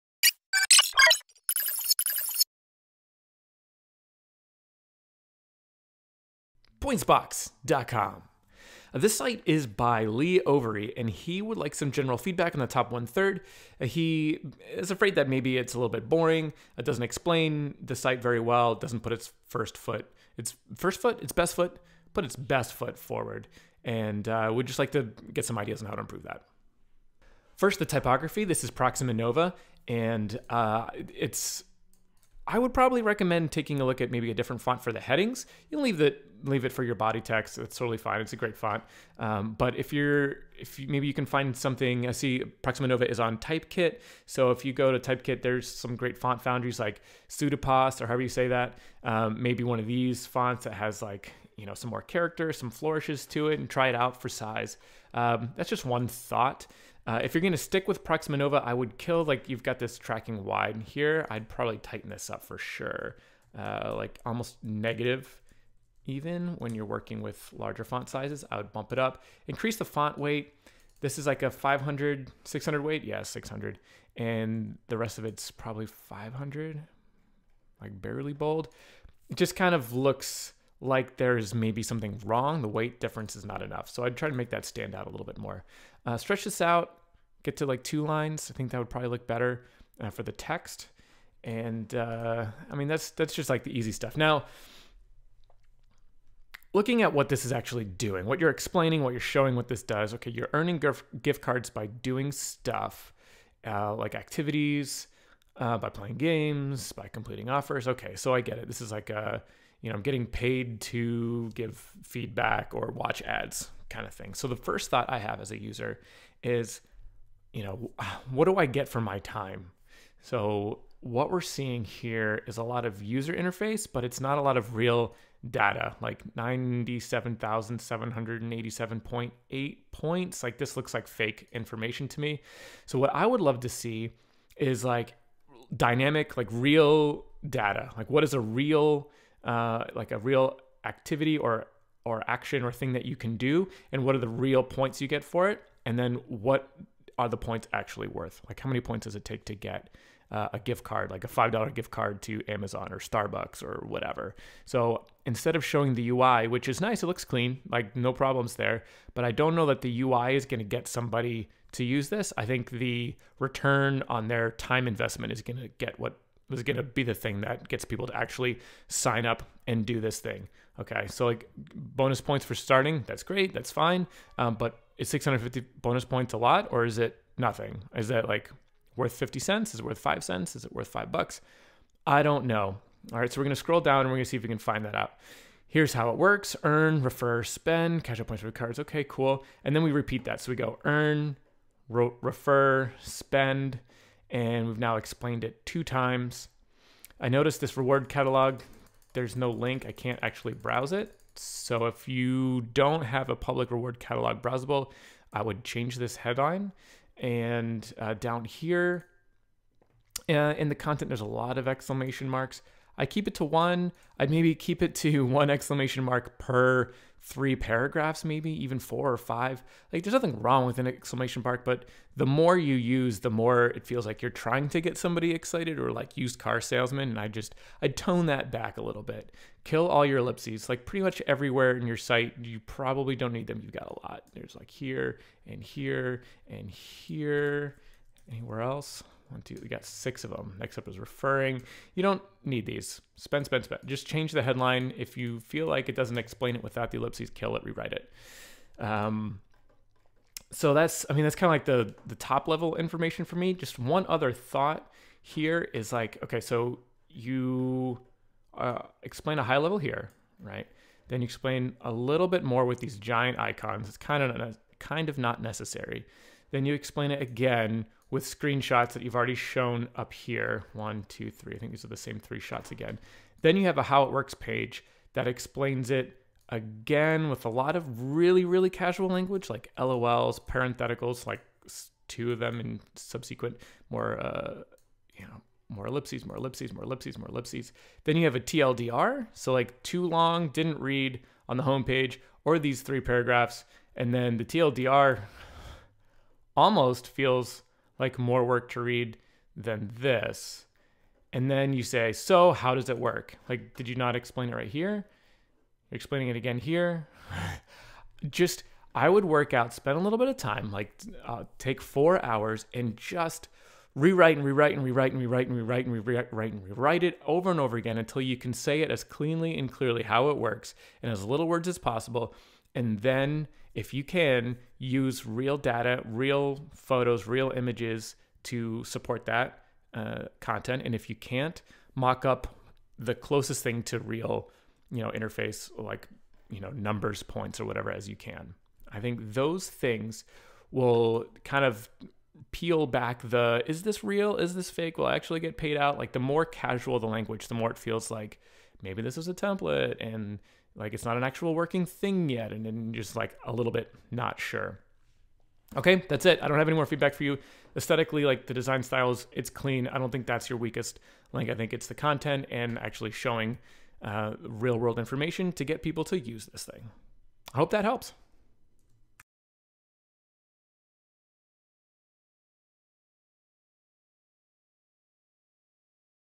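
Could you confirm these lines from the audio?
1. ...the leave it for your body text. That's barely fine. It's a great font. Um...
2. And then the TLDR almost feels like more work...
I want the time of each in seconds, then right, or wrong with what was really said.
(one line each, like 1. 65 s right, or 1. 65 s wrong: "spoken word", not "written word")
1. 35 s wrong: "totally", not "barely"
2. 293 s right.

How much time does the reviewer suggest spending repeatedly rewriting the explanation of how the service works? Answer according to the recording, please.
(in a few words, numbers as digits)
4 hours.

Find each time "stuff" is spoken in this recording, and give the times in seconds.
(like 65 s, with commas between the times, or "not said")
93 s, 102 s.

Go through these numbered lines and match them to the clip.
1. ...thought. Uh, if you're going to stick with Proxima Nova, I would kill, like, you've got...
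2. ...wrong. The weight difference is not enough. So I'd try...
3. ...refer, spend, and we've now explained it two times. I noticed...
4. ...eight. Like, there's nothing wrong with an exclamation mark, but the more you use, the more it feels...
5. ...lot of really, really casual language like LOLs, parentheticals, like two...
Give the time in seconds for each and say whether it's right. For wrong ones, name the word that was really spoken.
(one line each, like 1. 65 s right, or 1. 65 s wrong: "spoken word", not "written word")
1. 56 s right
2. 82 s right
3. 191 s right
4. 219 s wrong: "five", not "eight"
5. 277 s right.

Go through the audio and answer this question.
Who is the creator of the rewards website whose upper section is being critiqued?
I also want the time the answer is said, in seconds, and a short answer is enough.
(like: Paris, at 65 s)
Lee Overy, at 10 s.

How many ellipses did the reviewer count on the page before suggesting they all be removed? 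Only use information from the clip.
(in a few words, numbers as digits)
6.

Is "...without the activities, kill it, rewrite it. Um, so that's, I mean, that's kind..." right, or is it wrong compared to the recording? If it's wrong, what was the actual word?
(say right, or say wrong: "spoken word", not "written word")
wrong: "ellipses", not "activities".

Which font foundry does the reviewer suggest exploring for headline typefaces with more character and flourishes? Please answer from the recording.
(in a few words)
Sudtipos.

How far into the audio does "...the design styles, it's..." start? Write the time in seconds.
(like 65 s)
358 s.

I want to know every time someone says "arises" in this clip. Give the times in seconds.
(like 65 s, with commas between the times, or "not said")
not said.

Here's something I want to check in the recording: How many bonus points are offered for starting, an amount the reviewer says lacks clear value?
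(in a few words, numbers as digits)
650.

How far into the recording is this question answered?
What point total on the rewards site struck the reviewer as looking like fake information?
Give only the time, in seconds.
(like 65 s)
126 s.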